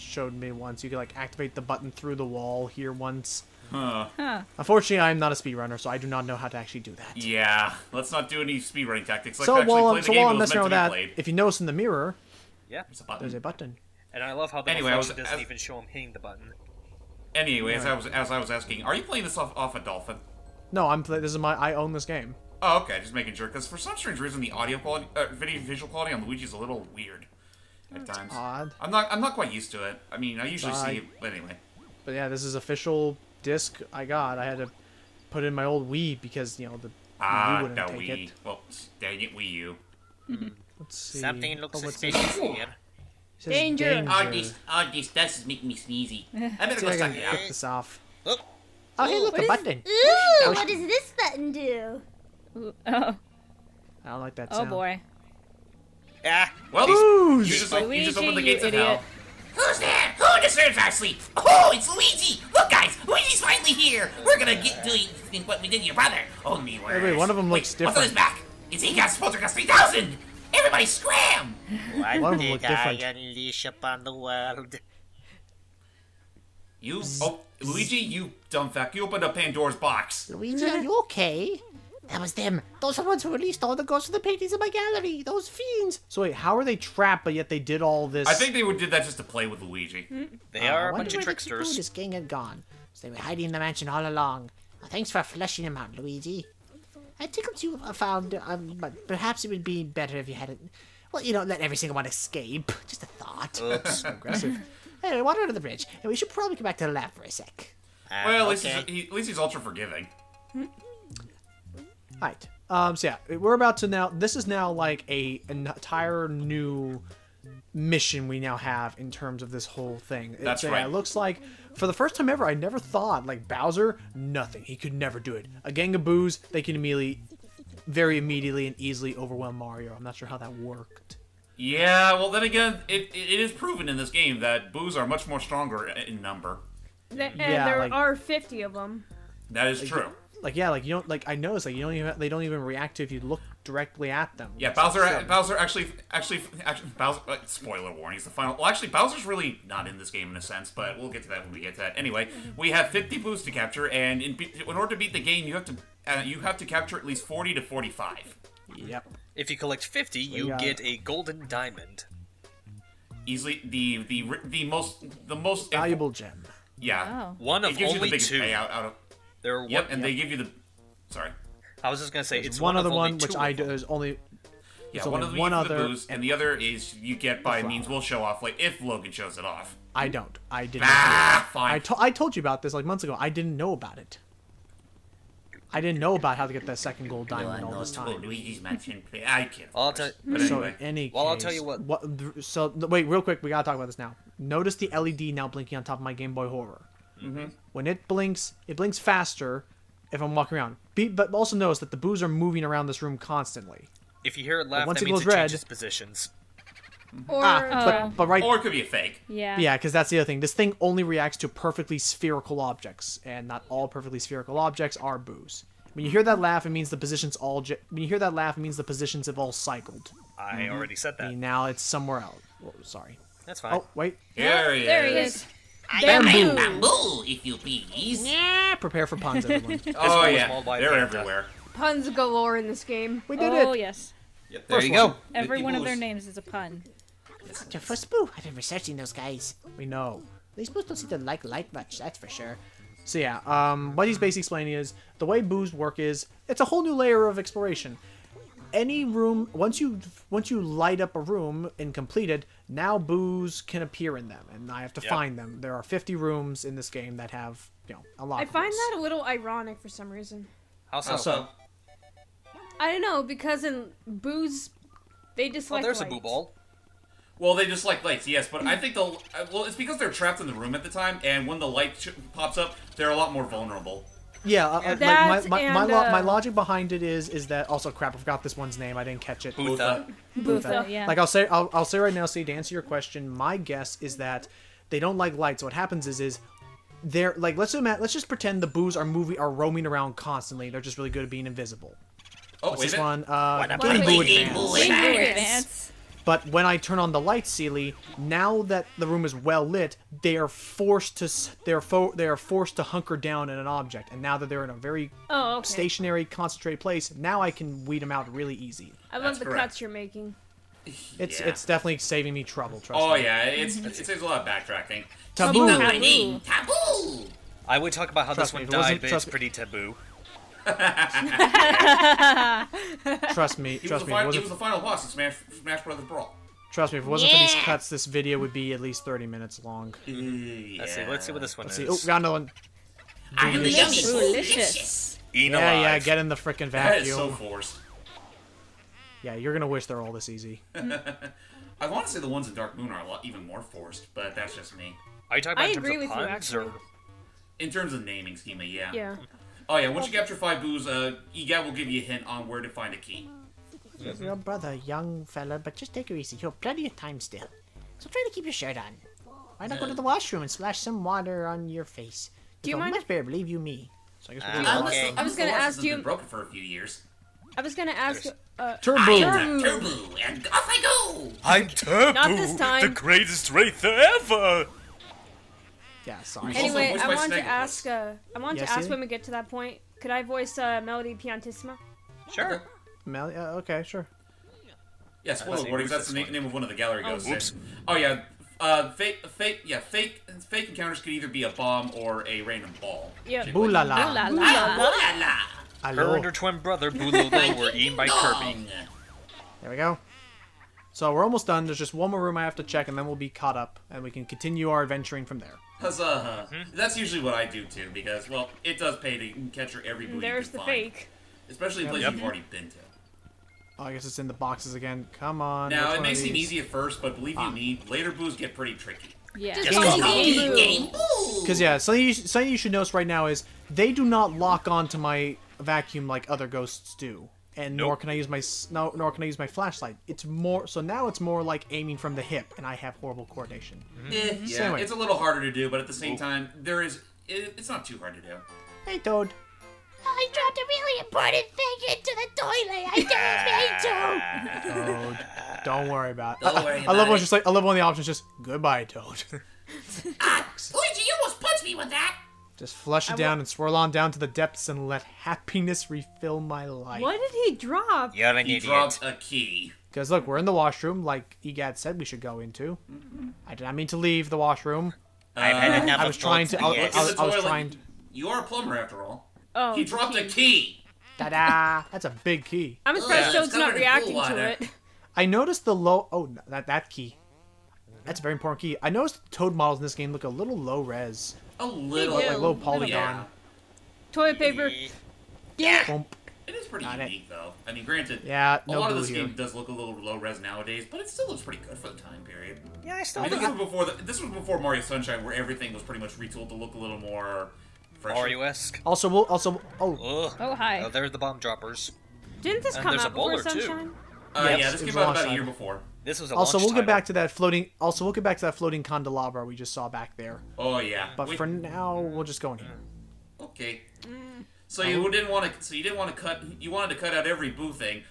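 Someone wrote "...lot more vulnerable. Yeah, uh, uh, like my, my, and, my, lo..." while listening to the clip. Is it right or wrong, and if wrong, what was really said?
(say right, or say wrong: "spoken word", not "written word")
right.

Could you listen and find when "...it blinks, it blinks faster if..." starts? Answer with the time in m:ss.
3:17.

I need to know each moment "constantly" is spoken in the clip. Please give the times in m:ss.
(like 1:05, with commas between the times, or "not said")
3:23, 4:50.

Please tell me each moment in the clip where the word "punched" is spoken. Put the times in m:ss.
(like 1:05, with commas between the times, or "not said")
7:31.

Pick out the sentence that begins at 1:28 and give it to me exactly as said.
I think they did that just to play with Luigi.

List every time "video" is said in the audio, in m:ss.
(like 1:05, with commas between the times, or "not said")
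0:25, 5:28.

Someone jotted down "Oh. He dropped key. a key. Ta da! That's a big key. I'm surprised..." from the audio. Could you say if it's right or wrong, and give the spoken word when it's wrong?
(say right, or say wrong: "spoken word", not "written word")
right.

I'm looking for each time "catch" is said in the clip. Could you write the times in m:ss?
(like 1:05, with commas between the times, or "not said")
4:39, 6:49.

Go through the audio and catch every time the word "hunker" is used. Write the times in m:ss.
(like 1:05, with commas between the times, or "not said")
5:02.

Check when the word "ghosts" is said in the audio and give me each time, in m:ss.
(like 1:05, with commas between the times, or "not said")
1:23, 6:27, 7:06.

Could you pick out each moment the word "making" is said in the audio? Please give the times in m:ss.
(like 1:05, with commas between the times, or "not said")
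0:23, 0:45, 5:09.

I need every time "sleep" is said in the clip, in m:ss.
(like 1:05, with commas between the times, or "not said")
1:00.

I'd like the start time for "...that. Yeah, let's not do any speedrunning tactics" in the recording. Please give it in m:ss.
0:06.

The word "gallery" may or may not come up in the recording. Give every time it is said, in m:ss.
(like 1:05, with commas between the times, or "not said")
1:24, 6:26.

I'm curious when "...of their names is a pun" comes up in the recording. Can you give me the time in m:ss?
3:55.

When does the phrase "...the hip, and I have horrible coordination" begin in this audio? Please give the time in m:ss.
7:12.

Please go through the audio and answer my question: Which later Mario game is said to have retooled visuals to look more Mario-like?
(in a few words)
Mario Sunshine.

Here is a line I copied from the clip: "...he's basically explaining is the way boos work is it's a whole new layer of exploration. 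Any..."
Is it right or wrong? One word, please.
right.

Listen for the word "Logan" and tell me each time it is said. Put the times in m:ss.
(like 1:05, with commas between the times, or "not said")
2:58.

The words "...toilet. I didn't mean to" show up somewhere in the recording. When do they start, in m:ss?
7:22.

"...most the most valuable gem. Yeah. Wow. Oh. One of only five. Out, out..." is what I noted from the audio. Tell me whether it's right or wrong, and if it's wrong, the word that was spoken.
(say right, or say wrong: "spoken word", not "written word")
wrong: "two", not "five".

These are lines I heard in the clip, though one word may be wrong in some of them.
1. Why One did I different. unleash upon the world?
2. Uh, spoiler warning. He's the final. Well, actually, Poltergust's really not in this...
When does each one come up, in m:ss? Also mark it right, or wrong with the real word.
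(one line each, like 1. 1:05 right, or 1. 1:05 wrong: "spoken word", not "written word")
1. 1:11 right
2. 2:27 wrong: "Bowser", not "Poltergust".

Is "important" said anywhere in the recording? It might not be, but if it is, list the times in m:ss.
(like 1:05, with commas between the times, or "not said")
7:20, 7:58.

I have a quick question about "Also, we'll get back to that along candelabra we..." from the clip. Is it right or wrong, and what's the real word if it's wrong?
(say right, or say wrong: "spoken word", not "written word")
wrong: "floating", not "along".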